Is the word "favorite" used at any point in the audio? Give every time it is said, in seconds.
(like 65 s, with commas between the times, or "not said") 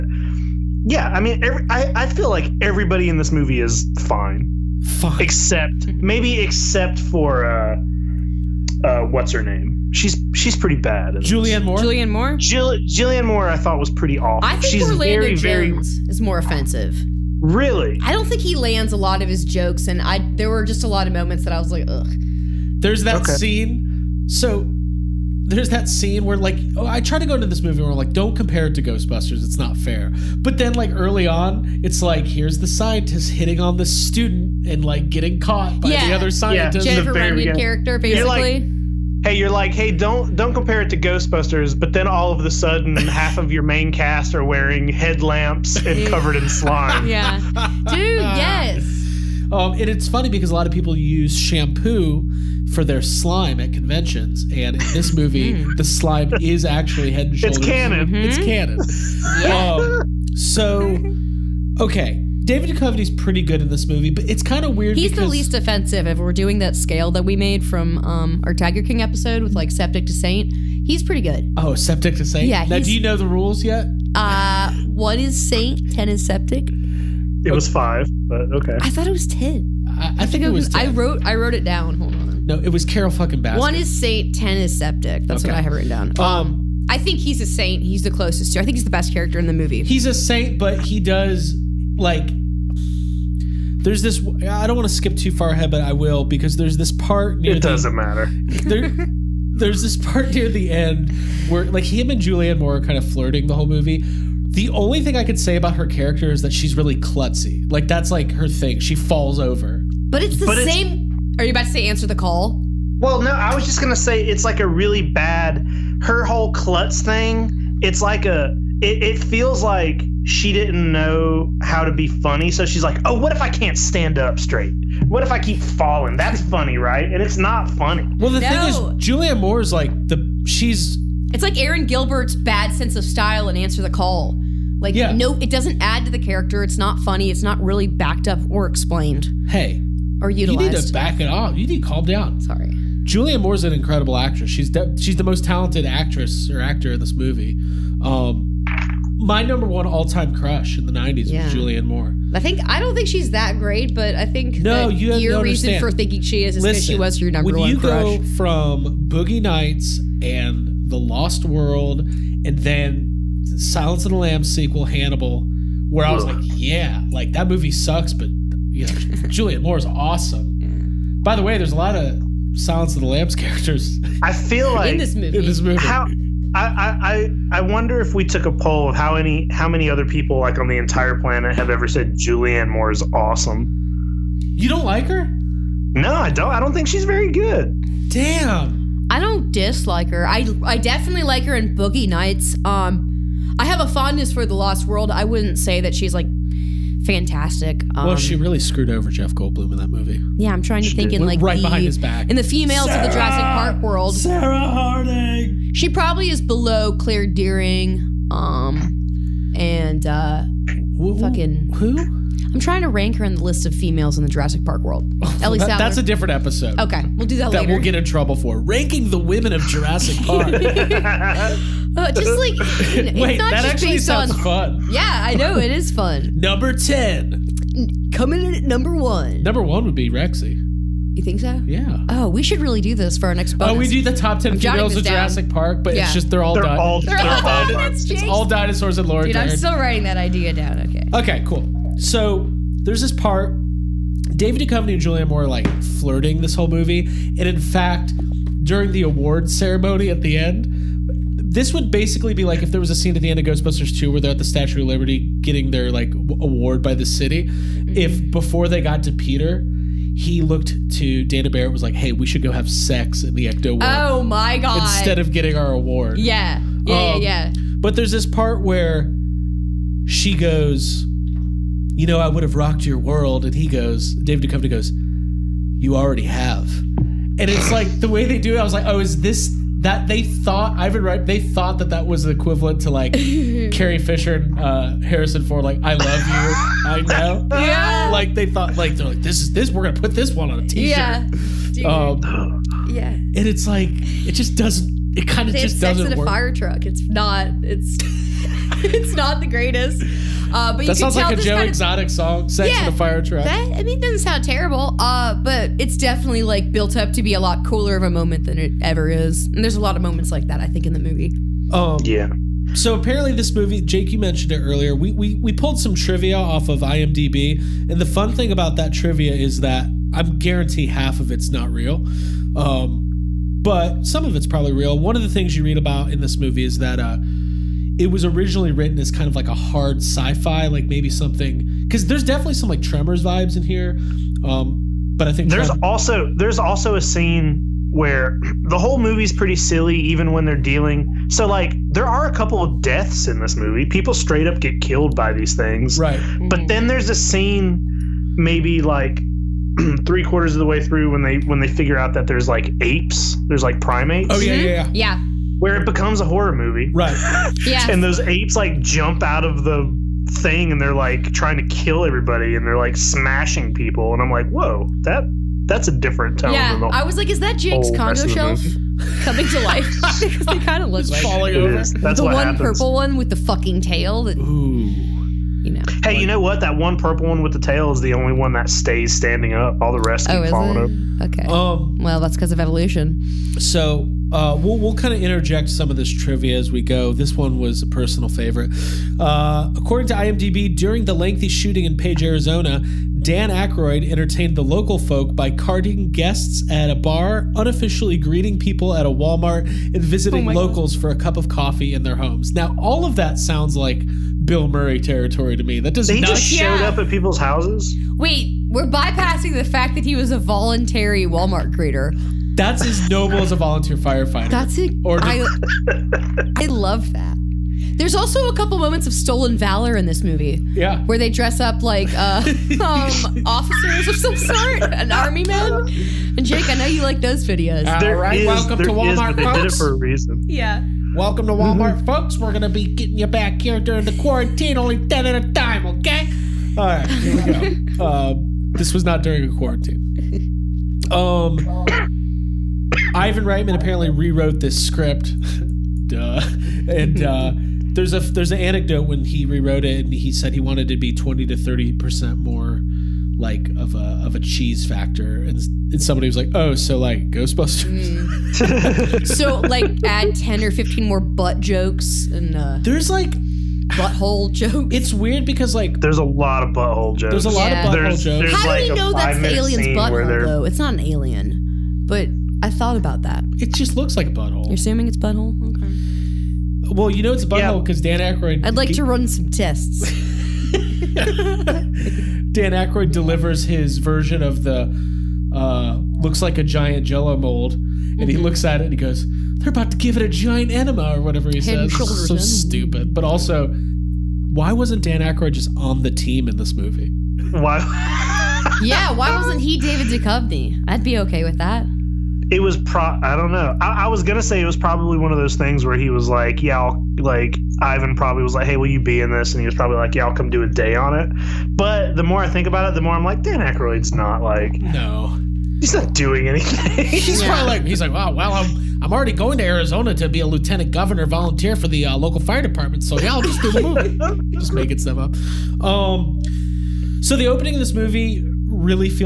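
388 s.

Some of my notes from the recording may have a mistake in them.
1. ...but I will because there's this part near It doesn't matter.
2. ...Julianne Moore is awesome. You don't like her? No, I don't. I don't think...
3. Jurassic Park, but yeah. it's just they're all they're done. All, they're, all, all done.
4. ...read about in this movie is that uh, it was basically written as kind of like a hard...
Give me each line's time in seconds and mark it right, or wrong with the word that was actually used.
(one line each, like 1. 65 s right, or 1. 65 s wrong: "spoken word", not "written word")
1. 95 s right
2. 182 s right
3. 235 s right
4. 325 s wrong: "originally", not "basically".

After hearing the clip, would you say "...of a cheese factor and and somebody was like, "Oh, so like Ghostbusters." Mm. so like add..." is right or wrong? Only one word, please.
right.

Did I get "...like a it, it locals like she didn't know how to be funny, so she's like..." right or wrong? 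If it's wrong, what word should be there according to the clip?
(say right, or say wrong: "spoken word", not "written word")
wrong: "feels", not "locals".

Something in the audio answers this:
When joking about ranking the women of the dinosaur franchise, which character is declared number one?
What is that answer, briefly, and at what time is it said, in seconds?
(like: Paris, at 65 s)
Rexy, at 230 s.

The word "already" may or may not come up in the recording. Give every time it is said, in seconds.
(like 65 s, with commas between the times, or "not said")
275 s, 519 s.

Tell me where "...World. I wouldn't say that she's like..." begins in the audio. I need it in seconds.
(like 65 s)
194 s.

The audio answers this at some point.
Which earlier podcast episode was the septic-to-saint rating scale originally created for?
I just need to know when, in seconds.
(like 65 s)
68 s.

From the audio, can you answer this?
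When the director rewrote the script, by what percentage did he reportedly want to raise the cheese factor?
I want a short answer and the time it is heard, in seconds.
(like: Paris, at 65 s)
20 to 30%, at 451 s.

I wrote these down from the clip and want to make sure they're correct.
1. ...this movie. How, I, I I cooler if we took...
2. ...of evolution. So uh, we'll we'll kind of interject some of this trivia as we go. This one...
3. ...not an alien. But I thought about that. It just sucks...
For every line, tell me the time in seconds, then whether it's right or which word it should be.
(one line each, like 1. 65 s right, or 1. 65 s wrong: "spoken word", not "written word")
1. 175 s wrong: "wonder", not "cooler"
2. 382 s right
3. 470 s wrong: "looks", not "sucks".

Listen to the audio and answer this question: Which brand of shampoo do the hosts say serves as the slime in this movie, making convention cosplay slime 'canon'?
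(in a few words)
Head and Shoulders.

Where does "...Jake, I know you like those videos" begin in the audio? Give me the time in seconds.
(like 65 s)
426 s.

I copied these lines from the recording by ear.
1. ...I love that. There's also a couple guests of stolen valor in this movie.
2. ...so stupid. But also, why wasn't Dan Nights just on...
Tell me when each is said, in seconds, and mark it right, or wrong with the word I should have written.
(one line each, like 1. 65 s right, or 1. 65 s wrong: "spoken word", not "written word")
1. 416 s wrong: "moments", not "guests"
2. 492 s wrong: "Aykroyd", not "Nights".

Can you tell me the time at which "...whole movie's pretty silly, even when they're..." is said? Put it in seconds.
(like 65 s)
338 s.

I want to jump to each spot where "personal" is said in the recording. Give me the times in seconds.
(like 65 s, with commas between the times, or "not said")
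387 s.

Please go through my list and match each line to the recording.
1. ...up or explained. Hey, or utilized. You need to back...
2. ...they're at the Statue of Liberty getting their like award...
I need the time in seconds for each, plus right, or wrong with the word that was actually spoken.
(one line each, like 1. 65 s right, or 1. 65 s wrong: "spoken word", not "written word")
1. 138 s right
2. 254 s right.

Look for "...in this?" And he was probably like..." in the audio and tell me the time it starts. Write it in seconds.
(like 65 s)
509 s.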